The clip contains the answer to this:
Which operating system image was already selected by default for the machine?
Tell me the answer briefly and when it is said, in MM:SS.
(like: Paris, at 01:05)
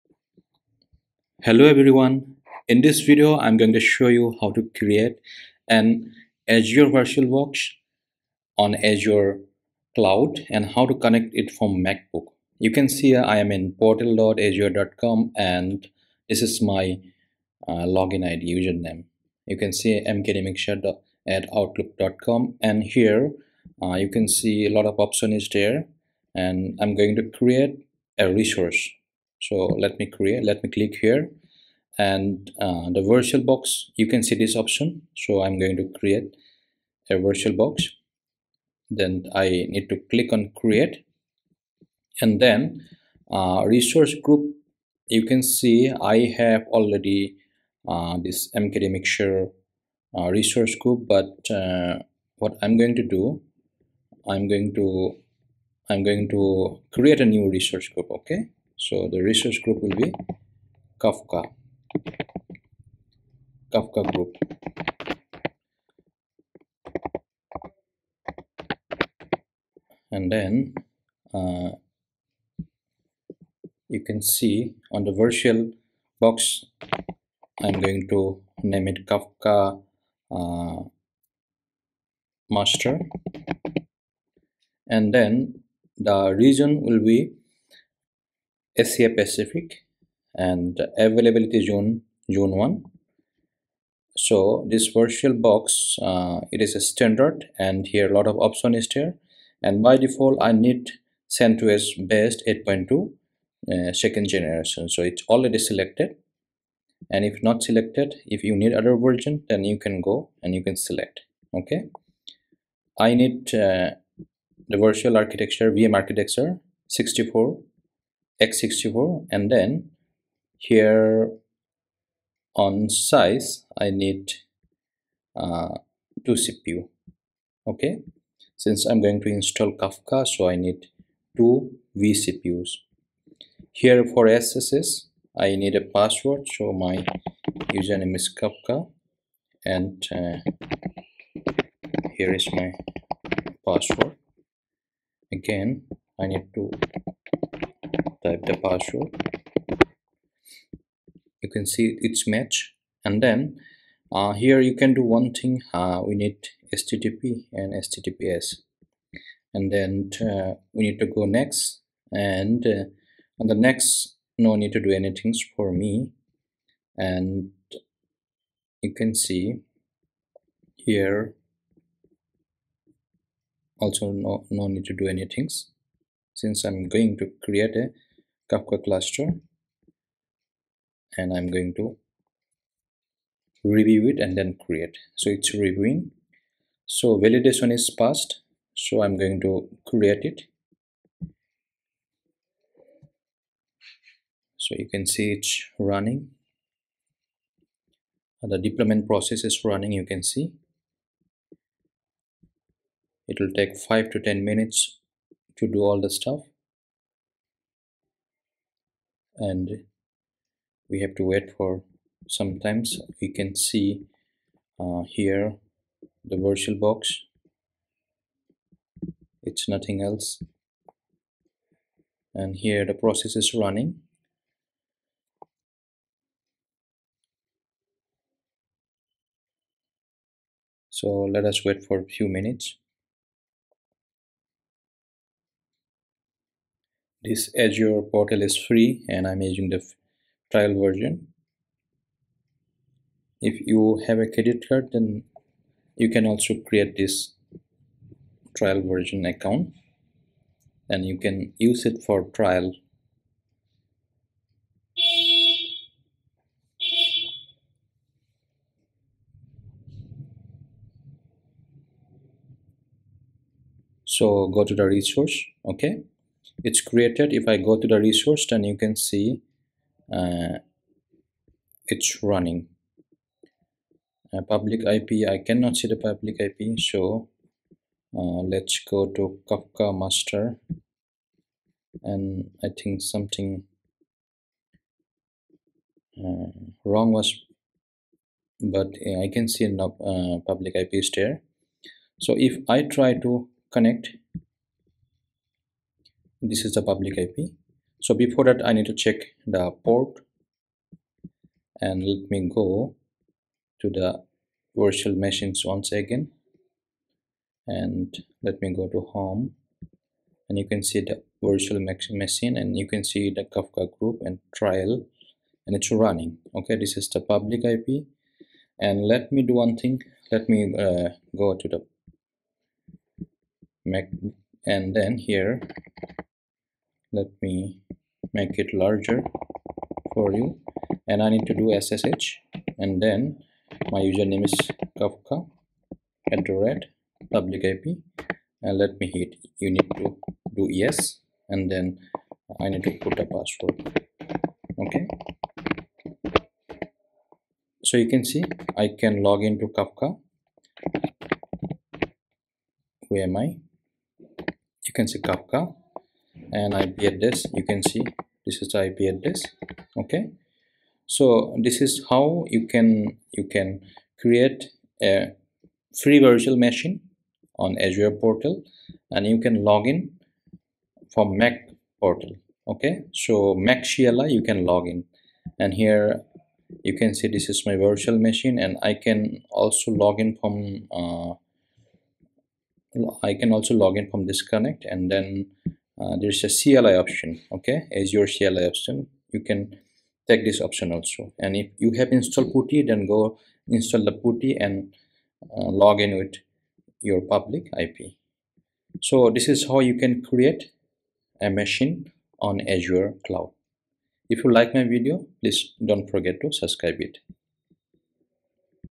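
CentOS, at 01:41.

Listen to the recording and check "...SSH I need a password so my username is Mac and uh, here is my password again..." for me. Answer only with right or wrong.
wrong.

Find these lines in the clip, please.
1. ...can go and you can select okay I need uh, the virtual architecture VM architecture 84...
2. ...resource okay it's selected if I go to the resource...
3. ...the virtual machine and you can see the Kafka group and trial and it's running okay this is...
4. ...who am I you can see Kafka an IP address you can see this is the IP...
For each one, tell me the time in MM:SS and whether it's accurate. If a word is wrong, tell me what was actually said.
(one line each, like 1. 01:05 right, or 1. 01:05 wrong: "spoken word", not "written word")
1. 01:49 wrong: "64", not "84"
2. 04:24 wrong: "created", not "selected"
3. 05:11 right
4. 05:53 right.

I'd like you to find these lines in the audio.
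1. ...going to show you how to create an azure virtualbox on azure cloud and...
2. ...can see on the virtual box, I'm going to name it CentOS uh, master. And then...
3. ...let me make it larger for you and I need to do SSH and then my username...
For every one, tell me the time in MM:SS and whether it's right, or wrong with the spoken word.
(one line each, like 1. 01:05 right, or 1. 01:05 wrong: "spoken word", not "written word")
1. 00:03 right
2. 01:14 wrong: "Kafka", not "CentOS"
3. 05:27 right.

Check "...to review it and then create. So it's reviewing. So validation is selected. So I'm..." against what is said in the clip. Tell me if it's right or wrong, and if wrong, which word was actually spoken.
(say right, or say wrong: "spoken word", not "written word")
wrong: "passed", not "selected".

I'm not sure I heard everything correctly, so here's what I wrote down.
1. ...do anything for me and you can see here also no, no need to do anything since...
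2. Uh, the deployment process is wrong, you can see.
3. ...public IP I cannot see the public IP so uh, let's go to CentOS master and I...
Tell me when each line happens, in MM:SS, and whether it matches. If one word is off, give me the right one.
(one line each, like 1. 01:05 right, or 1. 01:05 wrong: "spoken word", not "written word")
1. 02:44 right
2. 03:18 wrong: "running", not "wrong"
3. 04:34 wrong: "Kafka", not "CentOS".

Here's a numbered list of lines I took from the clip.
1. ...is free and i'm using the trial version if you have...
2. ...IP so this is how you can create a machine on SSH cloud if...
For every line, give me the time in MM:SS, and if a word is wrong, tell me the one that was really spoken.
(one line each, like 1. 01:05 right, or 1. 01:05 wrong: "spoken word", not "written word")
1. 03:58 right
2. 06:37 wrong: "Azure", not "SSH".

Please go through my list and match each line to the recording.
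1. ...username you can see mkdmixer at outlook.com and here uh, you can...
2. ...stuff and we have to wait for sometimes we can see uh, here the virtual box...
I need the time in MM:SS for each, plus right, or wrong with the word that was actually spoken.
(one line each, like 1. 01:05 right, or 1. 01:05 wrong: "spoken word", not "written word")
1. 00:18 right
2. 03:26 right.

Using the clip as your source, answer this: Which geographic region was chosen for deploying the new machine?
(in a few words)
Asia Pacific.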